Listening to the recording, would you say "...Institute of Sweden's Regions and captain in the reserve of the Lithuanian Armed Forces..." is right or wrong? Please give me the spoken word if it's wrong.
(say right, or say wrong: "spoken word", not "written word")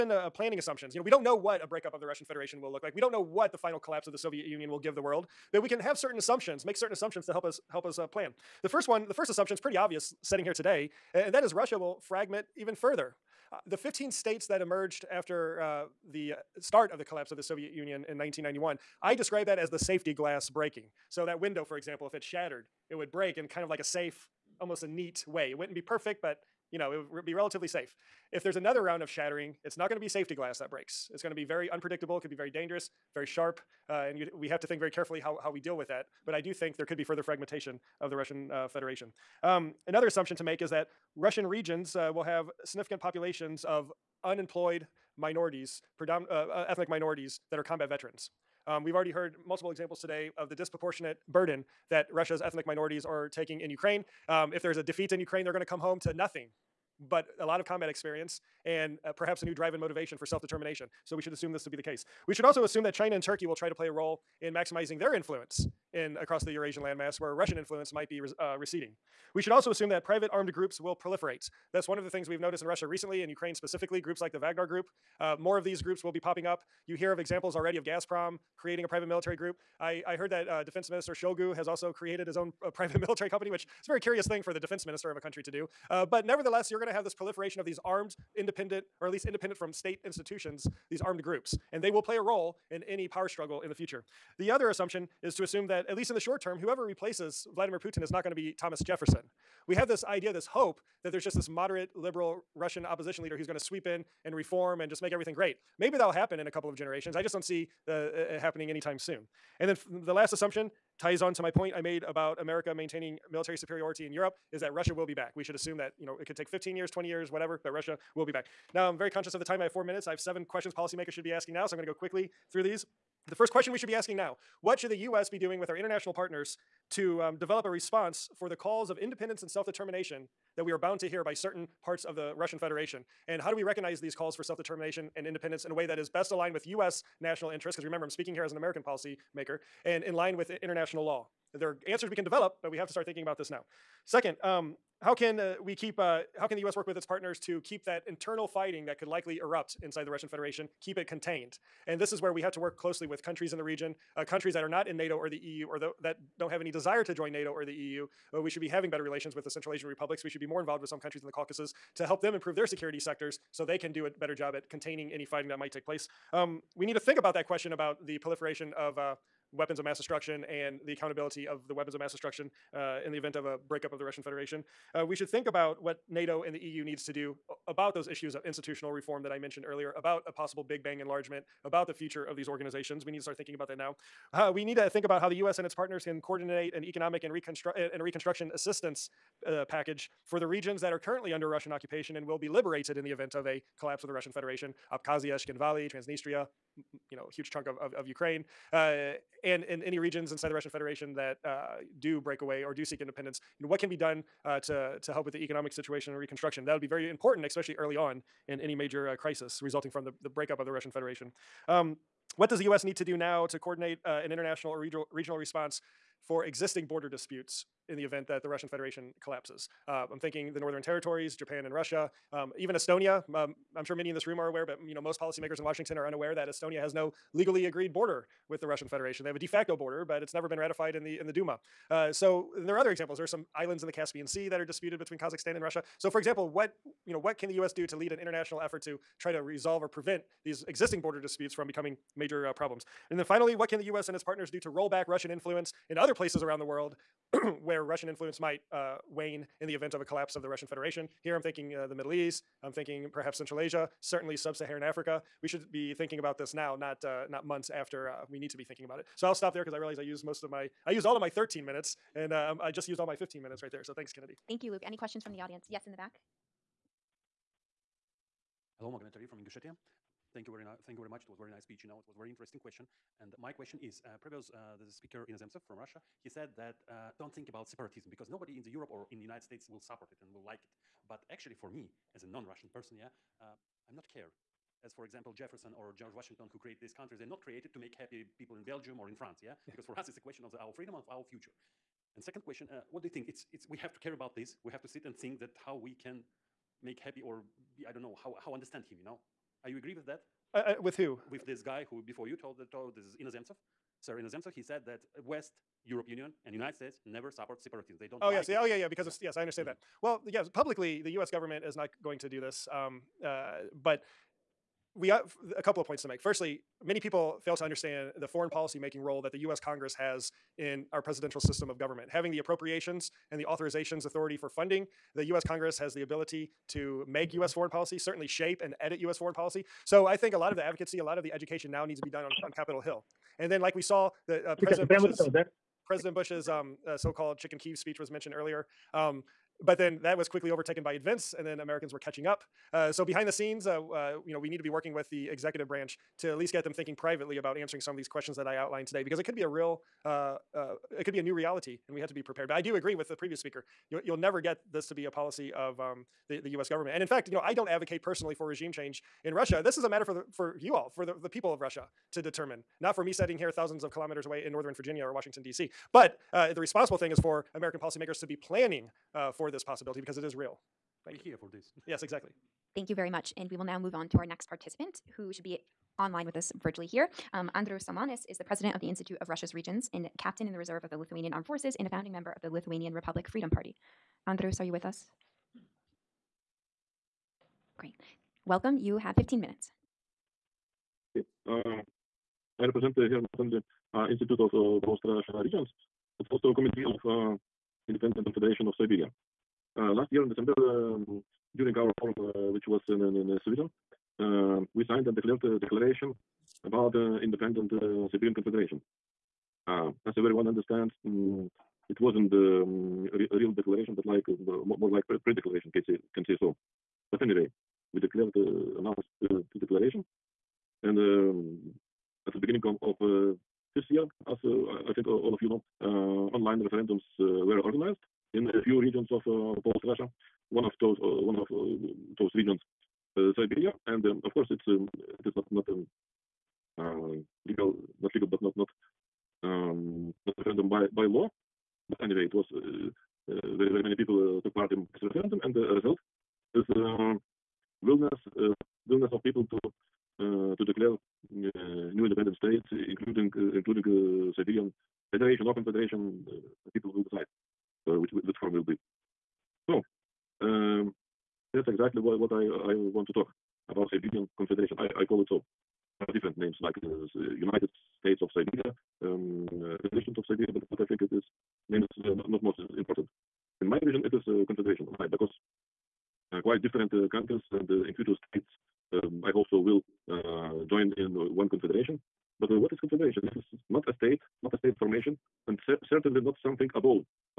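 wrong: "Russia", not "Sweden".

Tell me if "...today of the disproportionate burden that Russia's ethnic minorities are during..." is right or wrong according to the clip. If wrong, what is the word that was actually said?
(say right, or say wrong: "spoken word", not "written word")
wrong: "taking", not "during".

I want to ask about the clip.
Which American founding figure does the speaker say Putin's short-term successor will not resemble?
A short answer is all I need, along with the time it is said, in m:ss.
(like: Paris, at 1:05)
Thomas Jefferson, at 1:38.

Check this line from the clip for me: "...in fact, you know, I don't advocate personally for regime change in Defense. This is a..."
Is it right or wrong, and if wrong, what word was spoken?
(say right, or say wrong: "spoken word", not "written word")
wrong: "Russia", not "Defense".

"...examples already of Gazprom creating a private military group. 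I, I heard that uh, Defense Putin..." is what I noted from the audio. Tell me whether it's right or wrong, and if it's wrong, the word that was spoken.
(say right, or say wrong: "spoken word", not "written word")
wrong: "Minister", not "Putin".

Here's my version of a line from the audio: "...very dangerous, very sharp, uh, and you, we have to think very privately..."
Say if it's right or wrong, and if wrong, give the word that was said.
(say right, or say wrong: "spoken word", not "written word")
wrong: "carefully", not "privately".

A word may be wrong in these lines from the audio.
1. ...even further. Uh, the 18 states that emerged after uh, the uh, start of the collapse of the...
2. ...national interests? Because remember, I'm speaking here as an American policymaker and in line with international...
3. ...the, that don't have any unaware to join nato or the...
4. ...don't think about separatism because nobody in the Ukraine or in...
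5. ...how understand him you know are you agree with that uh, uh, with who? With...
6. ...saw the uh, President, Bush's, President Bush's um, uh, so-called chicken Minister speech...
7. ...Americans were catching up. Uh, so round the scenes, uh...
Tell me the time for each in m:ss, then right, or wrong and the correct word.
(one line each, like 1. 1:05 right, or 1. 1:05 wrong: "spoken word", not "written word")
1. 0:12 wrong: "15", not "18"
2. 2:17 right
3. 2:35 wrong: "desire", not "unaware"
4. 4:37 wrong: "Europe", not "Ukraine"
5. 4:58 right
6. 5:33 wrong: "Kiev", not "Minister"
7. 5:41 wrong: "behind", not "round".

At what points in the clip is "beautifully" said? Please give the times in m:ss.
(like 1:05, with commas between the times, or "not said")
not said.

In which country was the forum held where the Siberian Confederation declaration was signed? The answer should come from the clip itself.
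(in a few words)
Sweden.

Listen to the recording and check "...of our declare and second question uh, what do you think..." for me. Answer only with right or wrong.
wrong.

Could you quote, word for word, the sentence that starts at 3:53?
There are some islands in the Caspian Sea that are disputed between Kazakhstan and Russia.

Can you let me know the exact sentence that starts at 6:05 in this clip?
But uh, the responsible thing is for American policymakers to be planning uh, for this possibility because it is real.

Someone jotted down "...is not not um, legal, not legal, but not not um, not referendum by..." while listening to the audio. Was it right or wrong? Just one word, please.
right.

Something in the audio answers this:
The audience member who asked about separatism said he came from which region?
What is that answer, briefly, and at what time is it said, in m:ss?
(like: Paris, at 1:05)
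Ingushetia, at 4:29.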